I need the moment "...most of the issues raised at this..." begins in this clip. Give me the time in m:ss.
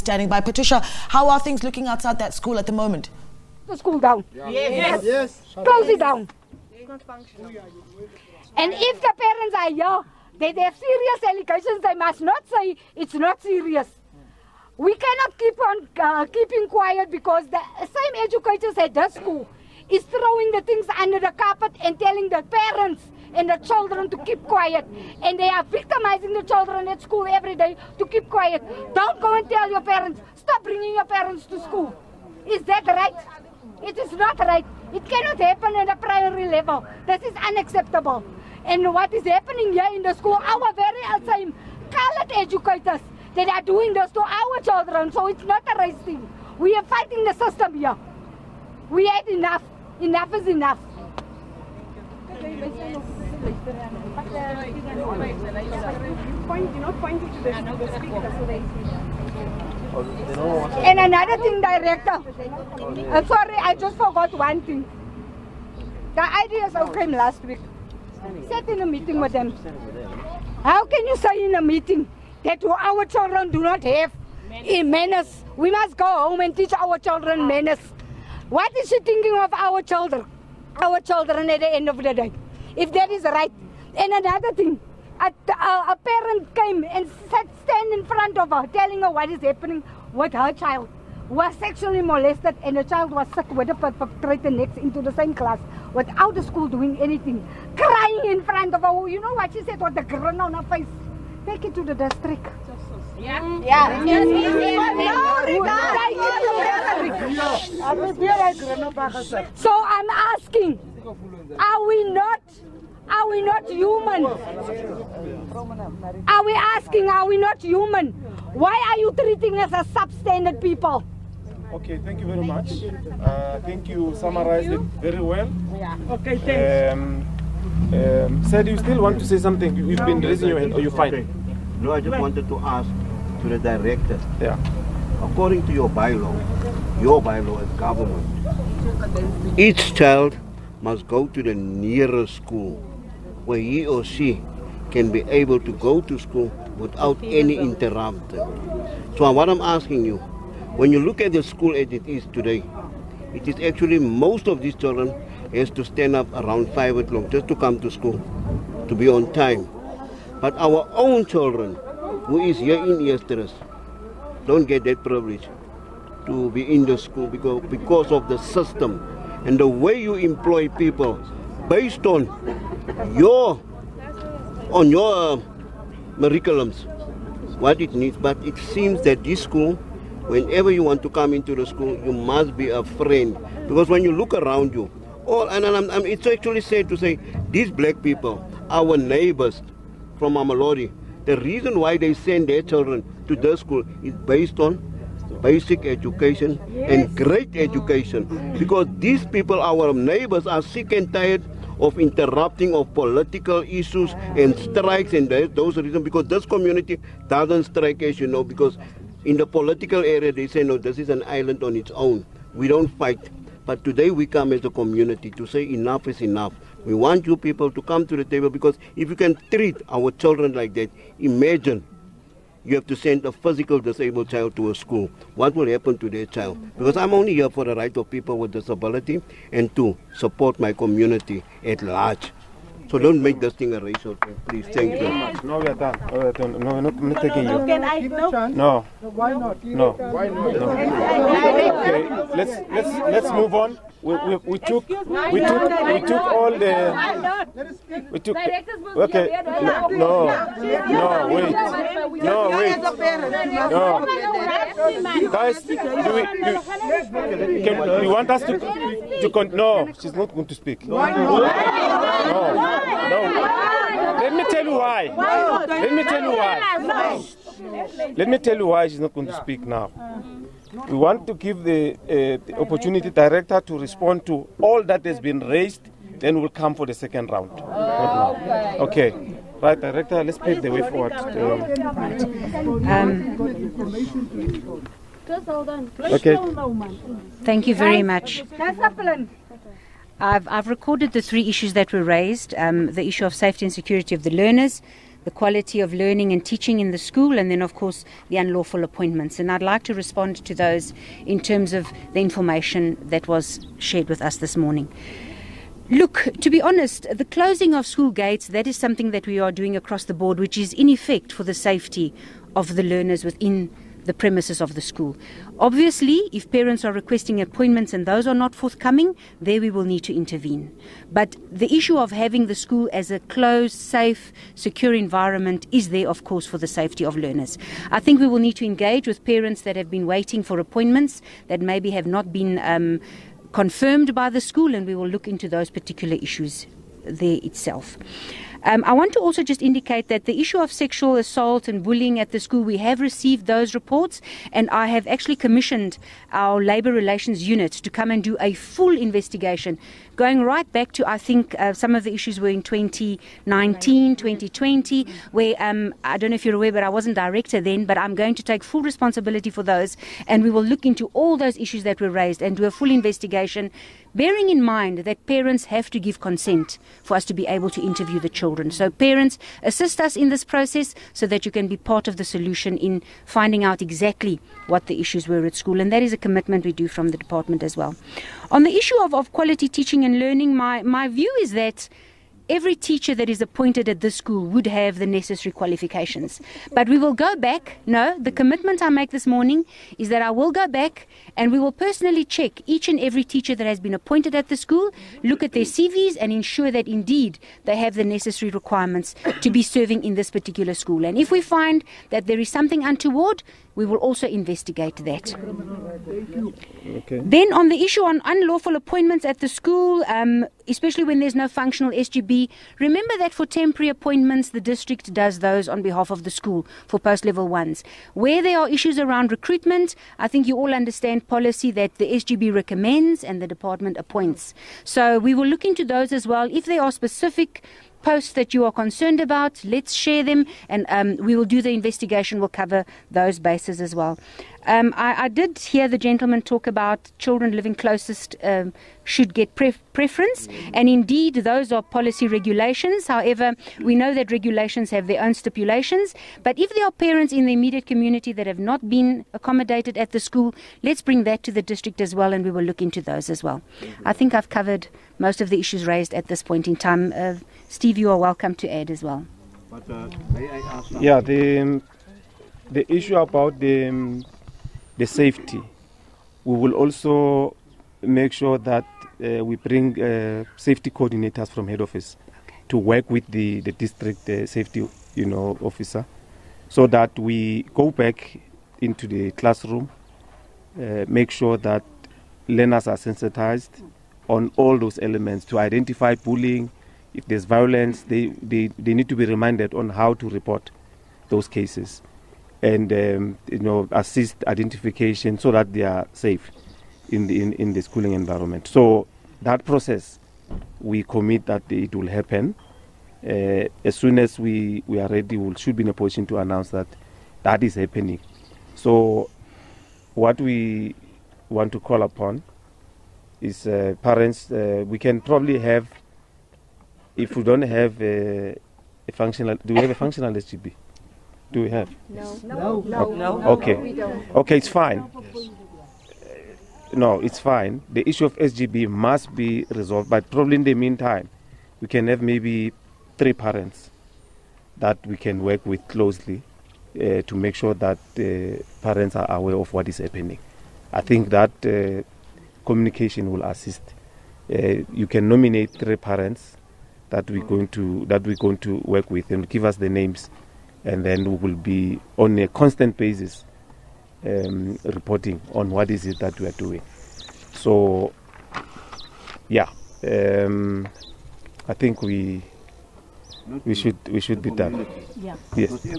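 7:35.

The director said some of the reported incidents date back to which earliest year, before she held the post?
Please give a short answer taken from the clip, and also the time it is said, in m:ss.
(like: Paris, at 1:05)
2019, at 5:52.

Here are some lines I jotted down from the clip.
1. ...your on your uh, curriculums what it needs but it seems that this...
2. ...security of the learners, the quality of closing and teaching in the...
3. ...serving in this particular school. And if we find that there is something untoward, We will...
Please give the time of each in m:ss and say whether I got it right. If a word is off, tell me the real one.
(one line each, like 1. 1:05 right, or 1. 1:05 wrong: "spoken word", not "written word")
1. 2:53 right
2. 4:53 wrong: "learning", not "closing"
3. 6:39 right.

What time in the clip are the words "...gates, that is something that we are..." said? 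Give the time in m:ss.
5:08.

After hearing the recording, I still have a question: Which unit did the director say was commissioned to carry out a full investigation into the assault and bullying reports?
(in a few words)
labour relations unit.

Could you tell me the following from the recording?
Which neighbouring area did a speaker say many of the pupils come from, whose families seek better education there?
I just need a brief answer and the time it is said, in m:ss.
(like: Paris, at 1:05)
Mamelodi, at 3:10.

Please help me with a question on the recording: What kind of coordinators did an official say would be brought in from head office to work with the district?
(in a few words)
safety coordinators.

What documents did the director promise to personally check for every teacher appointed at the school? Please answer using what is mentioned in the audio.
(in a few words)
CVs.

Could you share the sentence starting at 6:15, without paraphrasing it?
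And that is a commitment we do from the department as well.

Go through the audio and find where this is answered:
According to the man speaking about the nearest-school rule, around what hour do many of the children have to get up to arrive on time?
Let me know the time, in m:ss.
2:36.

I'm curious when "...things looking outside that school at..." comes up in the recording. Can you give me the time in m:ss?
0:01.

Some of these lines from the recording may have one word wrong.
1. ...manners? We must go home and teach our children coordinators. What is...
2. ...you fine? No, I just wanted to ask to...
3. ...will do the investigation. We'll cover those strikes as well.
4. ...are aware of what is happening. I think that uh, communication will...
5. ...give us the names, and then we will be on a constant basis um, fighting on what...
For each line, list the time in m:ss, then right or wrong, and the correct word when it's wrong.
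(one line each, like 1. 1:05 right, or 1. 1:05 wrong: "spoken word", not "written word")
1. 1:14 wrong: "manners", not "coordinators"
2. 2:10 right
3. 7:11 wrong: "bases", not "strikes"
4. 8:59 right
5. 9:09 wrong: "reporting", not "fighting".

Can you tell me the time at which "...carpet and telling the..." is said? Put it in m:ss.
0:21.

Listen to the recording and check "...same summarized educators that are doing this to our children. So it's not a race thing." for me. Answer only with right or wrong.
wrong.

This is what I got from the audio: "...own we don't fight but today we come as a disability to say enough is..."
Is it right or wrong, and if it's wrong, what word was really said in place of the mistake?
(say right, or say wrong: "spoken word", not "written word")
wrong: "community", not "disability".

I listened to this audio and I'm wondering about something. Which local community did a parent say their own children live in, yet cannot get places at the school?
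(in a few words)
Eersterust.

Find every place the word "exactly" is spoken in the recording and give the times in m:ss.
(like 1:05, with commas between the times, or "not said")
6:13.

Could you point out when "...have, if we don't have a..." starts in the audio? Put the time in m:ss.
8:35.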